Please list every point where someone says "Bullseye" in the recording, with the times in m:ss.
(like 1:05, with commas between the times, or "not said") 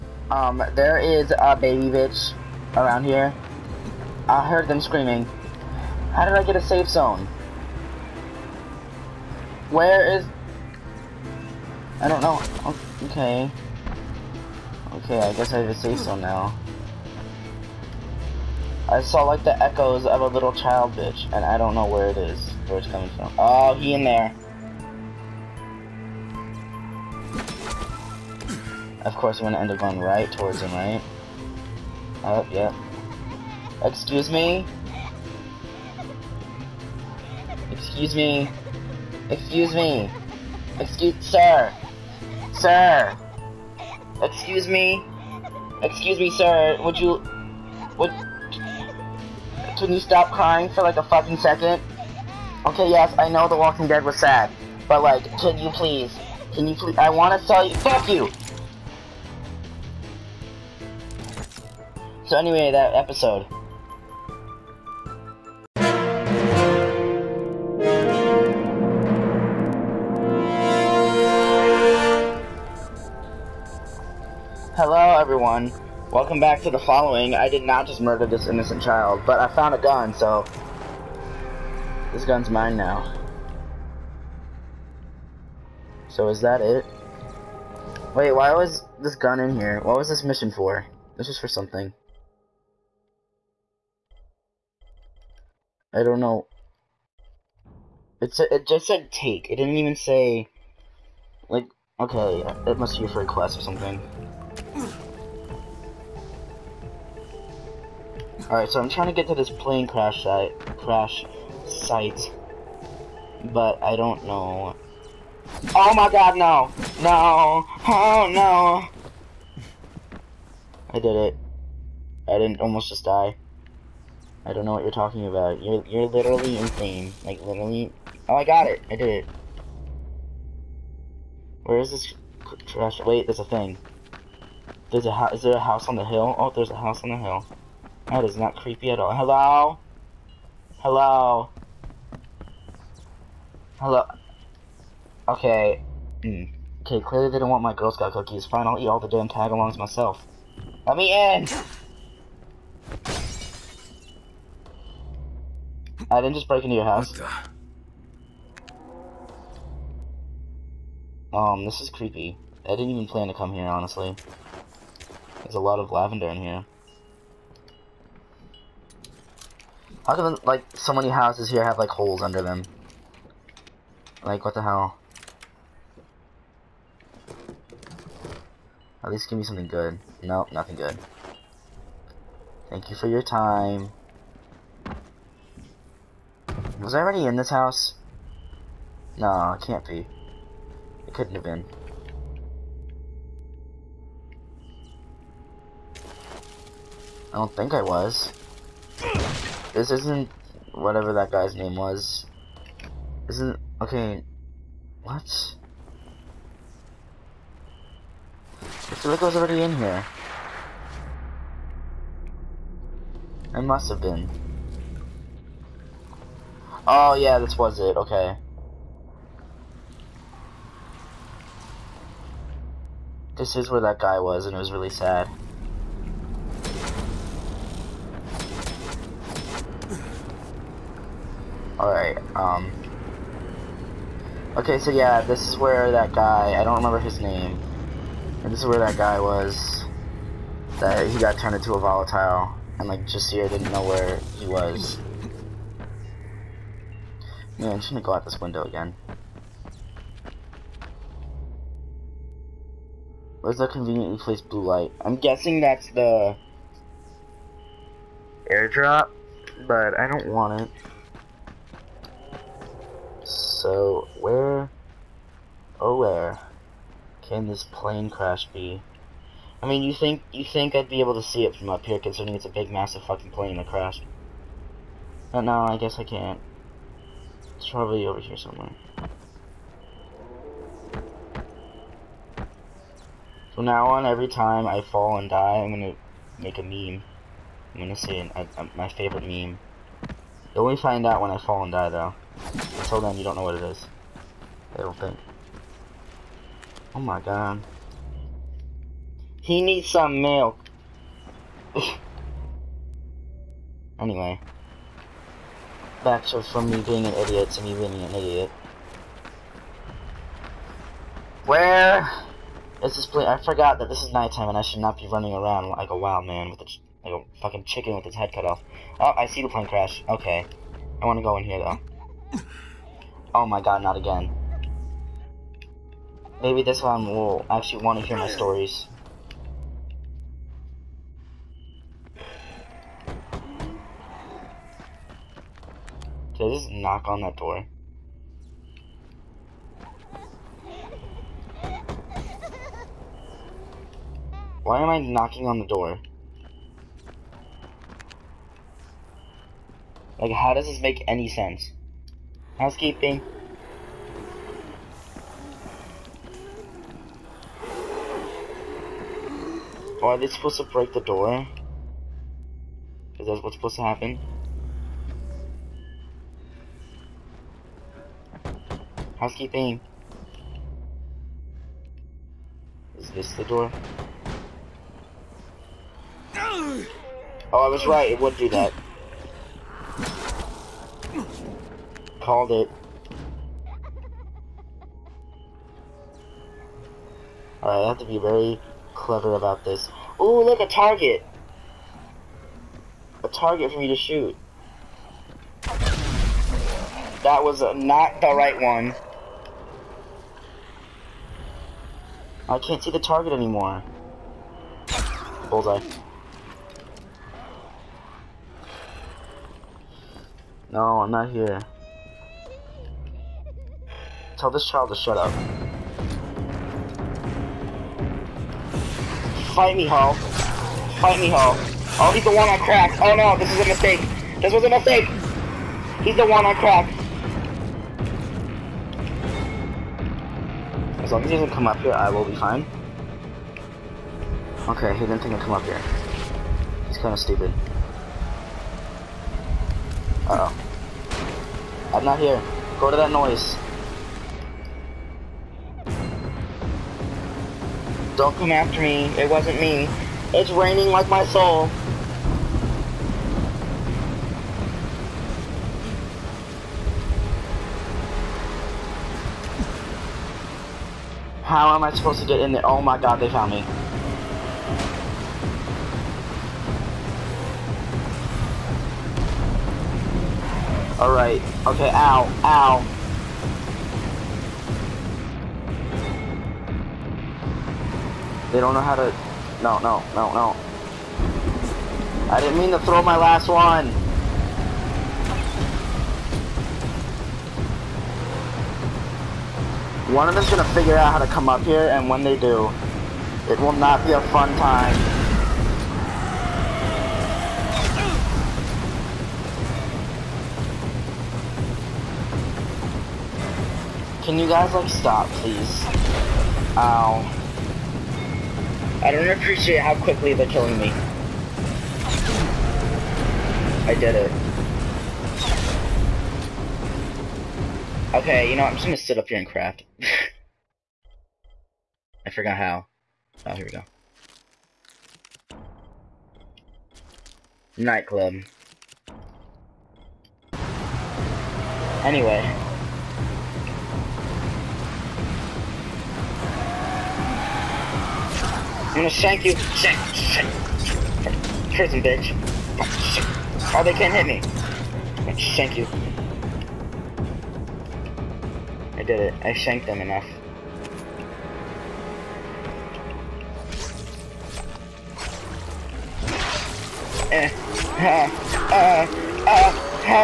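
6:45.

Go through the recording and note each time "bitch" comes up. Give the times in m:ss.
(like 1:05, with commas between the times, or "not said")
0:01, 0:20, 9:02.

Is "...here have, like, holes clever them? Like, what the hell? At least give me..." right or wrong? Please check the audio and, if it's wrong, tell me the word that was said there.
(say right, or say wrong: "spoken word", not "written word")
wrong: "under", not "clever".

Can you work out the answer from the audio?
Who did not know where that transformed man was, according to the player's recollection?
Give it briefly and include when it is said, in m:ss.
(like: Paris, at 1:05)
Jasir, at 4:03.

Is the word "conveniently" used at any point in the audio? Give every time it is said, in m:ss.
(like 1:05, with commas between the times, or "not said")
4:13.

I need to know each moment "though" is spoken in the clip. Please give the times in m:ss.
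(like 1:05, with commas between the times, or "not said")
4:51, 5:21.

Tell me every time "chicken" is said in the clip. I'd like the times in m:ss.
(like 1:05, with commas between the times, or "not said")
5:17.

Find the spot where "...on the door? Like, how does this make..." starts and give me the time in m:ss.
5:45.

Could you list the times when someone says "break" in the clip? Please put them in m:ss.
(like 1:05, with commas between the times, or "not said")
2:36, 6:00.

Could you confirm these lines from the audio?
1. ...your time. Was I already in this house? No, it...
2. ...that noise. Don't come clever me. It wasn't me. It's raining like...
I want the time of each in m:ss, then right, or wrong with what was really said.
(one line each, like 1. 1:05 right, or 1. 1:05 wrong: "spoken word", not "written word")
1. 3:03 right
2. 7:22 wrong: "after", not "clever".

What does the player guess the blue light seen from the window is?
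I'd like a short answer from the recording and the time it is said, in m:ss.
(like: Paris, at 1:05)
The airdrop, at 4:15.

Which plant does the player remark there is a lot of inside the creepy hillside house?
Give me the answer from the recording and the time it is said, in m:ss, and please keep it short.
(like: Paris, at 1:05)
Lavender, at 2:45.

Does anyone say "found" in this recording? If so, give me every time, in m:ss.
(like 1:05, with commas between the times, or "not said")
1:19, 7:43.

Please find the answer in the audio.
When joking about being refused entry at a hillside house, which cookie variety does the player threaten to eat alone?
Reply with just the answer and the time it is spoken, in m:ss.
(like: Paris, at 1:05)
Tagalongs, at 2:29.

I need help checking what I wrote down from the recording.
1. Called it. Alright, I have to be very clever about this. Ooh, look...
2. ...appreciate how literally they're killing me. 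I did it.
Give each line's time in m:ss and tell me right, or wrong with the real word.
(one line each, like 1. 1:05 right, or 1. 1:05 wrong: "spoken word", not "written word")
1. 6:22 right
2. 8:29 wrong: "quickly", not "literally".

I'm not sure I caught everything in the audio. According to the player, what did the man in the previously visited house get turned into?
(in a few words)
A volatile.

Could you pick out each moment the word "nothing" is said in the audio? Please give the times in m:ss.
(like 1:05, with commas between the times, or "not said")
3:00.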